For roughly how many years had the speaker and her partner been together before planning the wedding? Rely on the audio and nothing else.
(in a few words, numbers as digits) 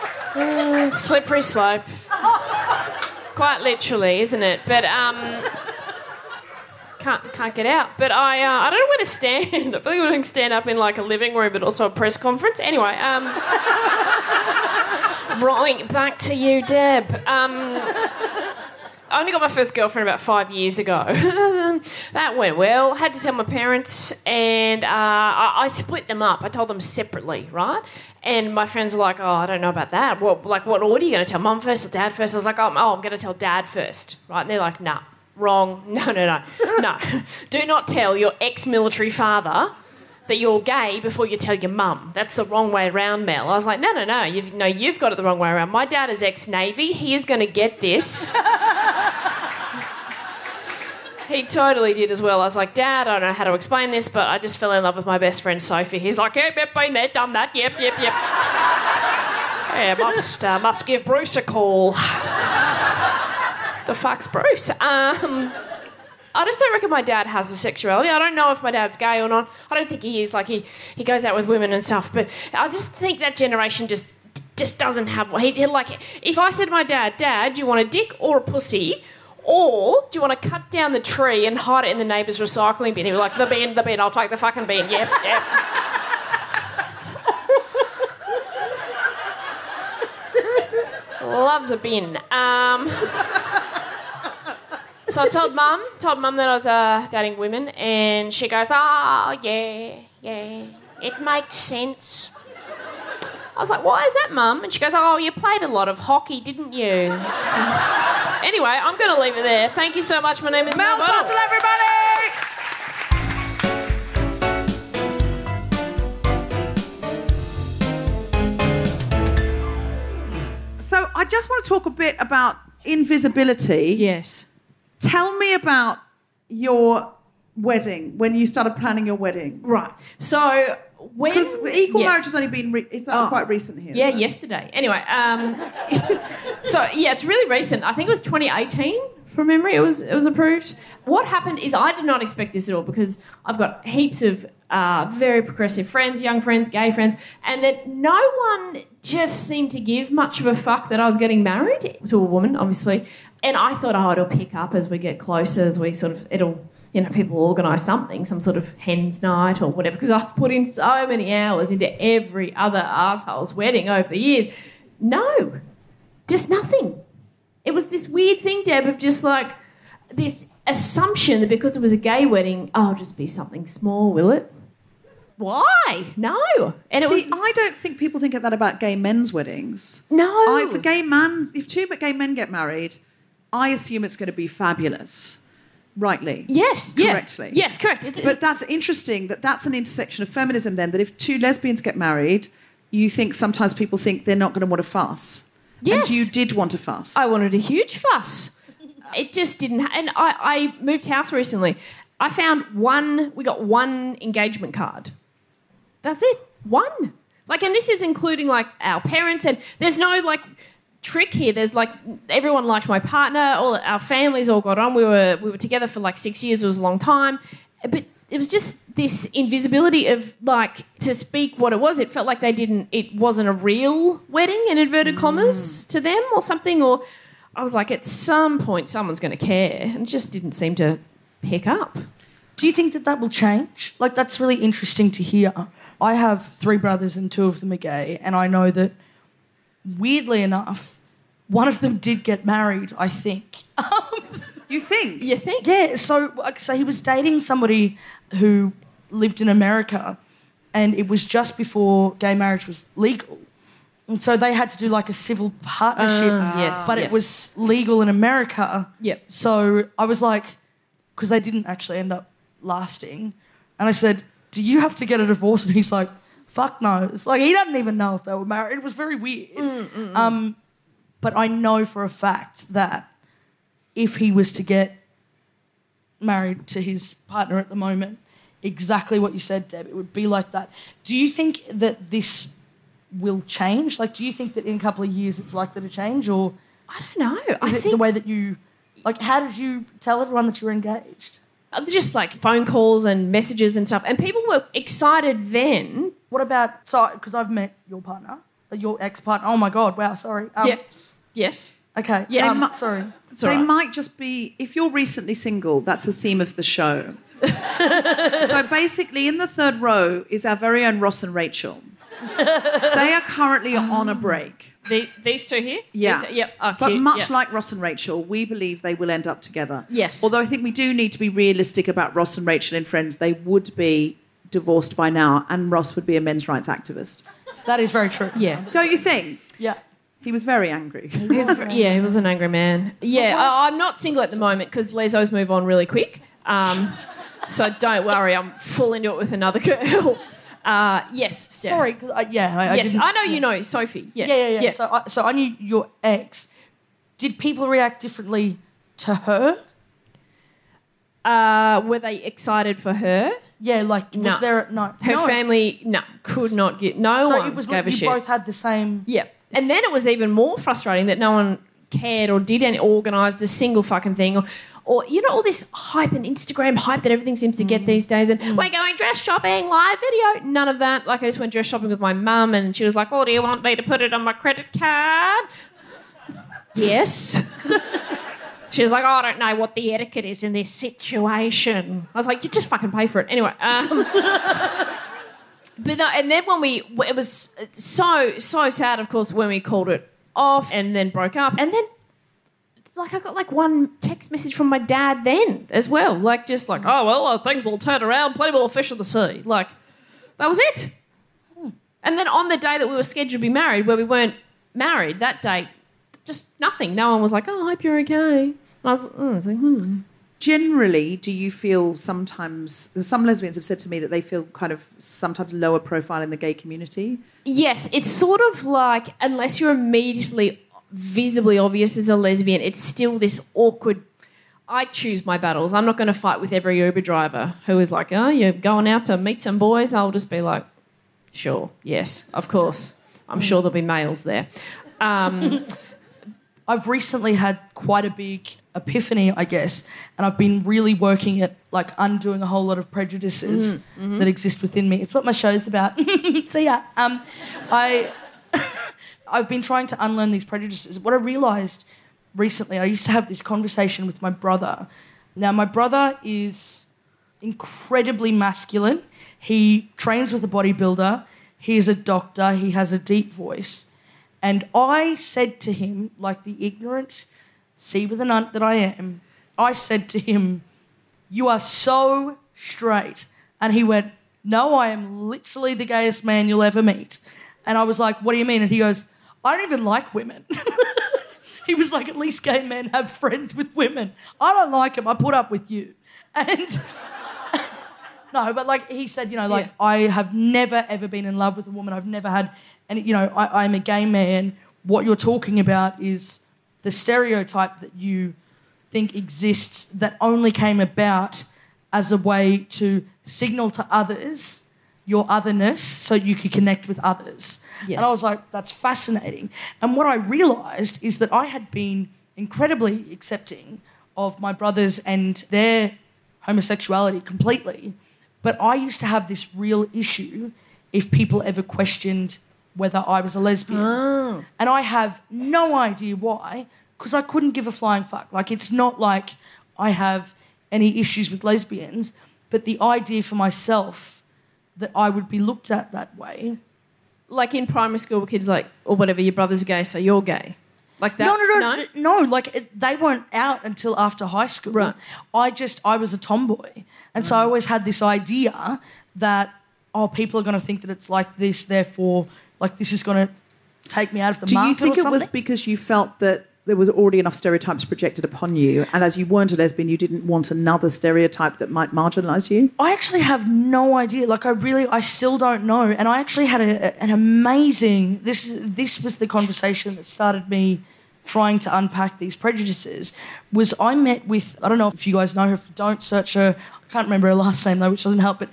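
6 years.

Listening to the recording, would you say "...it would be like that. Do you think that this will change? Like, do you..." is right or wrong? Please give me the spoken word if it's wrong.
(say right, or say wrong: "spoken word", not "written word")
right.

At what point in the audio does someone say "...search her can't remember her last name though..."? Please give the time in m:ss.
9:36.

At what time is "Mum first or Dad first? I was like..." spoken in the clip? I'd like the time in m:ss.
0:31.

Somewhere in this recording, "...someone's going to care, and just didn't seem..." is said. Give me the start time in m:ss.
3:48.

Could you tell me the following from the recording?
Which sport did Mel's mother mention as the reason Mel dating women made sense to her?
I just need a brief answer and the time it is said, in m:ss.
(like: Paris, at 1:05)
Hockey, at 1:45.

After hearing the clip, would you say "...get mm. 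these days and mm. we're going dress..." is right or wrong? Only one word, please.
right.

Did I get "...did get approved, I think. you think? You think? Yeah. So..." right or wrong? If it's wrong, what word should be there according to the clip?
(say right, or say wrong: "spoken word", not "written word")
wrong: "married", not "approved".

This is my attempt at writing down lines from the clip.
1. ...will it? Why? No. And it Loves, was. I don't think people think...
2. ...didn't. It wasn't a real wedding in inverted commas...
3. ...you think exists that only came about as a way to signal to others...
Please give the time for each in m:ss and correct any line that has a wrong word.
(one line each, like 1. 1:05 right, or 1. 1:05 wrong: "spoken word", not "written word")
1. 2:54 wrong: "See", not "Loves"
2. 3:42 right
3. 8:17 right.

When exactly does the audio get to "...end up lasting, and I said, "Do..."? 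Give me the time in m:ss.
4:21.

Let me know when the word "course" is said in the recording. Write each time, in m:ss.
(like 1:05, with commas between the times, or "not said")
6:29, 7:12.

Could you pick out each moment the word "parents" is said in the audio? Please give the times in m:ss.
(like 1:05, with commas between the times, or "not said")
0:23, 3:29.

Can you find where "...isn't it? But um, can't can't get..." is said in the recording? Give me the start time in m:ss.
0:04.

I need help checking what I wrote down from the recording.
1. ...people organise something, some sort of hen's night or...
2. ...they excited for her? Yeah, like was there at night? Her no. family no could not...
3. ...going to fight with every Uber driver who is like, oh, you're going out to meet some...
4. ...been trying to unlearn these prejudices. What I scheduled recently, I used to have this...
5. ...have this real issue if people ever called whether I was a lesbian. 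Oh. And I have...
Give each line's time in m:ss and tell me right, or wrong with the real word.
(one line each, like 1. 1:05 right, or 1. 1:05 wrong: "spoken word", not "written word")
1. 2:37 right
2. 5:51 right
3. 7:05 right
4. 7:29 wrong: "realised", not "scheduled"
5. 8:39 wrong: "questioned", not "called".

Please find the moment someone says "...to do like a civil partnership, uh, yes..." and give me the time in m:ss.
4:14.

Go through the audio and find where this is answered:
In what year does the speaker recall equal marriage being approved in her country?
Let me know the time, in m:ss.
2:18.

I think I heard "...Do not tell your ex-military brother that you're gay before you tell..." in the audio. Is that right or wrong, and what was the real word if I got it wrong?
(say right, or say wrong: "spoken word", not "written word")
wrong: "father", not "brother".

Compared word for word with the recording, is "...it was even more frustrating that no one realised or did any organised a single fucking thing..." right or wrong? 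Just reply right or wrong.
wrong.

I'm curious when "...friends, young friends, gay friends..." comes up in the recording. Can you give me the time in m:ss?
2:25.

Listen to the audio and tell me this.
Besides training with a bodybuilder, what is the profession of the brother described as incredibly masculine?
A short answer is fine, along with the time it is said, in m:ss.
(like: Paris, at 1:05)
Doctor, at 7:41.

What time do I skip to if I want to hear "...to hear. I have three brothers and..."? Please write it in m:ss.
3:55.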